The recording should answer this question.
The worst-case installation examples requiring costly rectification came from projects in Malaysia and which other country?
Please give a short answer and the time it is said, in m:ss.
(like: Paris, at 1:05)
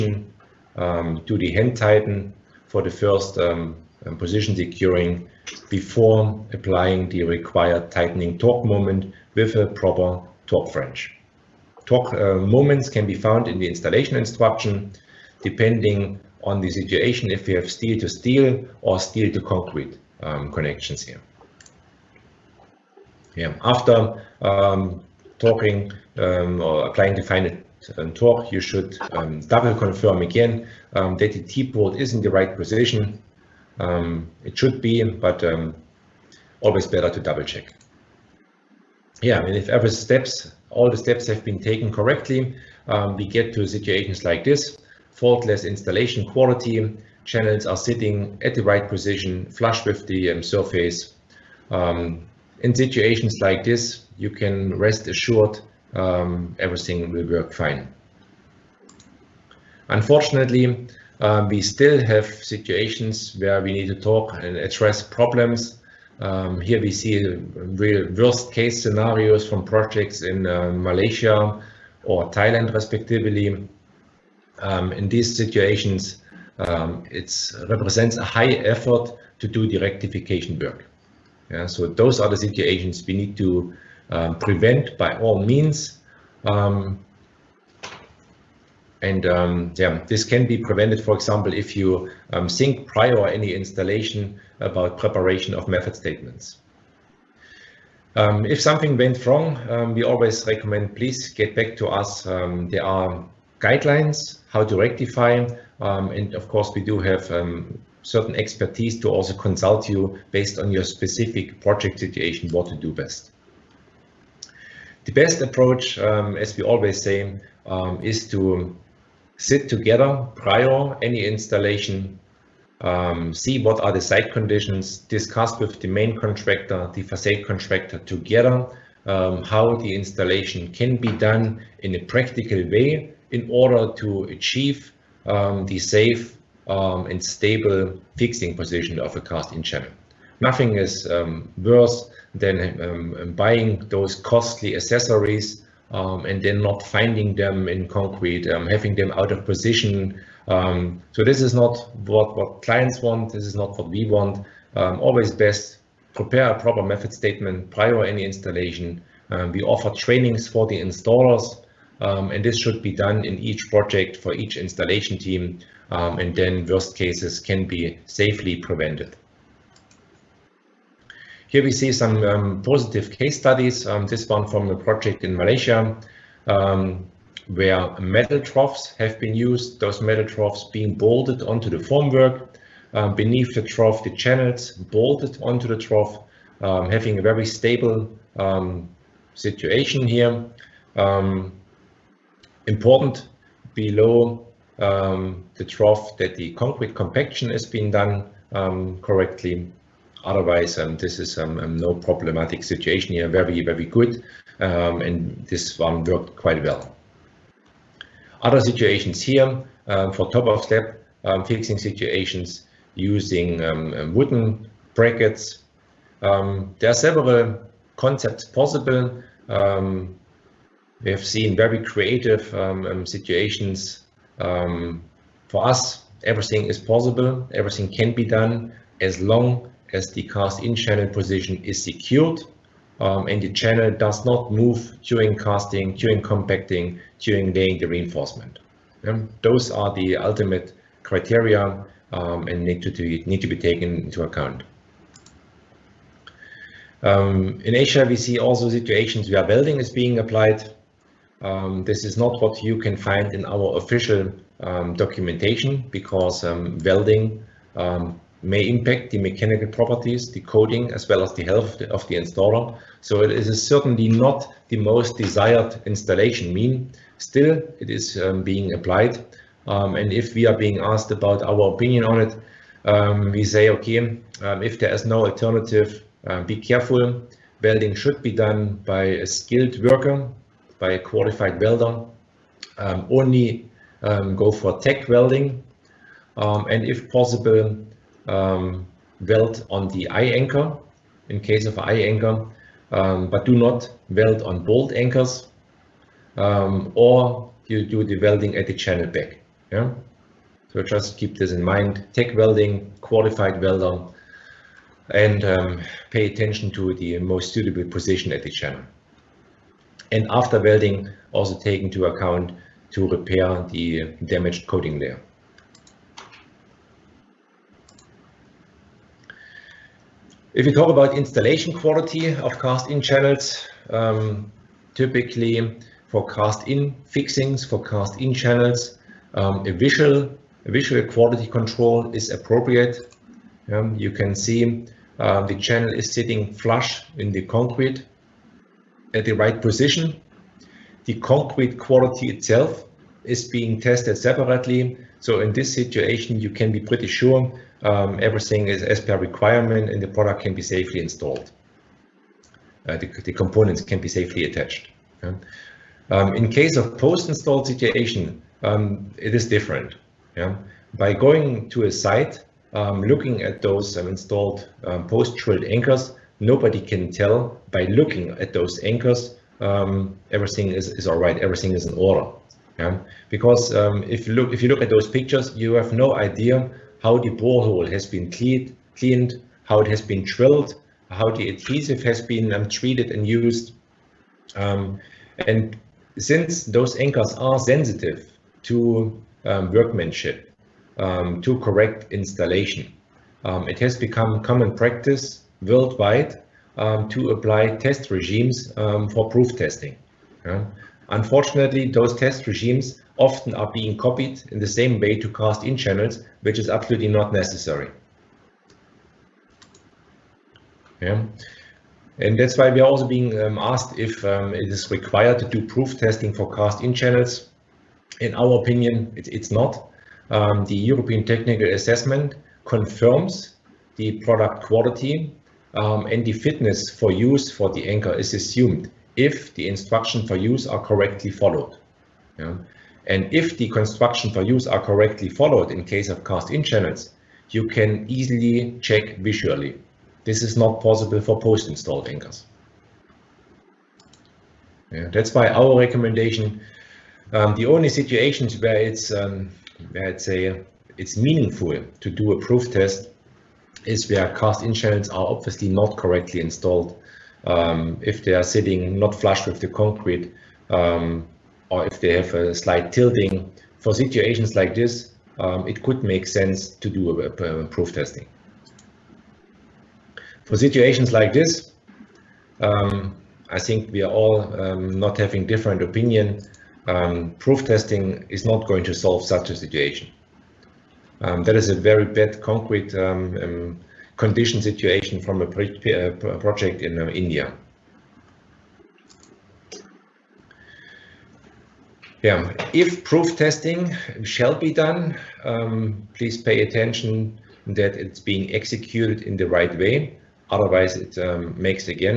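Thailand, at 1:12.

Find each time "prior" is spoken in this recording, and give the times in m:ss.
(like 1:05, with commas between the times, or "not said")
1:32, 2:00, 2:37.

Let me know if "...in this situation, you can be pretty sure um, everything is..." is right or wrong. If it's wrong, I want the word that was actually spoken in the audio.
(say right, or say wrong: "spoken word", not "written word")
right.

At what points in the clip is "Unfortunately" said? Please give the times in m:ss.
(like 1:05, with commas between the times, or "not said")
0:59, 6:41.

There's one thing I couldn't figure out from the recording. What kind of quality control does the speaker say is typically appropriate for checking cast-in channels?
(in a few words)
visual quality control.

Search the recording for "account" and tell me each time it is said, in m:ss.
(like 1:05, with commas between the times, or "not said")
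4:04, 5:12.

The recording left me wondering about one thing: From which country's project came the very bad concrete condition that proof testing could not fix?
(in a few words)
India.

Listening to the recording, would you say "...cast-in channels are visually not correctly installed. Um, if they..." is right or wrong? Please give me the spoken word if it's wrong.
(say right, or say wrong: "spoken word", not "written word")
wrong: "obviously", not "visually".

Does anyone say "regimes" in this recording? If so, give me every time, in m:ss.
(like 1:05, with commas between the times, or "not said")
6:38, 6:42.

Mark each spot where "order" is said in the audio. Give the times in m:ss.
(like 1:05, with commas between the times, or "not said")
2:13, 6:11.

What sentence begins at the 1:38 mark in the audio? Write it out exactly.
Um, if something went wrong, um, we always recommend please get back to us.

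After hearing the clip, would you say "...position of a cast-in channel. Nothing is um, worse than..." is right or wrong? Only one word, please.
right.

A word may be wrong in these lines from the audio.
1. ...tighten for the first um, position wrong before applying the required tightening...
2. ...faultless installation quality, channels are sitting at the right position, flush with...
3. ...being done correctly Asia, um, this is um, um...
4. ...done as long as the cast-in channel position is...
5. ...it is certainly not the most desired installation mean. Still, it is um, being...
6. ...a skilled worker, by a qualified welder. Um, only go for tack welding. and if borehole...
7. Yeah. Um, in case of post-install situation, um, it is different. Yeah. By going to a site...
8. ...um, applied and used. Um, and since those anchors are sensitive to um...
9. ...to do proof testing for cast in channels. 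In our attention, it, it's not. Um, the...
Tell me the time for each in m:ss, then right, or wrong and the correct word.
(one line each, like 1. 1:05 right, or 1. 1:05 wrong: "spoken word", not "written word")
1. 0:01 wrong: "securing", not "wrong"
2. 0:45 right
3. 3:17 wrong: "Otherwise", not "Asia"
4. 3:48 right
5. 4:23 right
6. 4:39 wrong: "possible", not "borehole"
7. 5:55 right
8. 6:22 wrong: "treated", not "applied"
9. 6:55 wrong: "opinion", not "attention".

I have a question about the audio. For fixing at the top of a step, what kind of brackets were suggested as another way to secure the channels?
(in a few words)
wooden brackets.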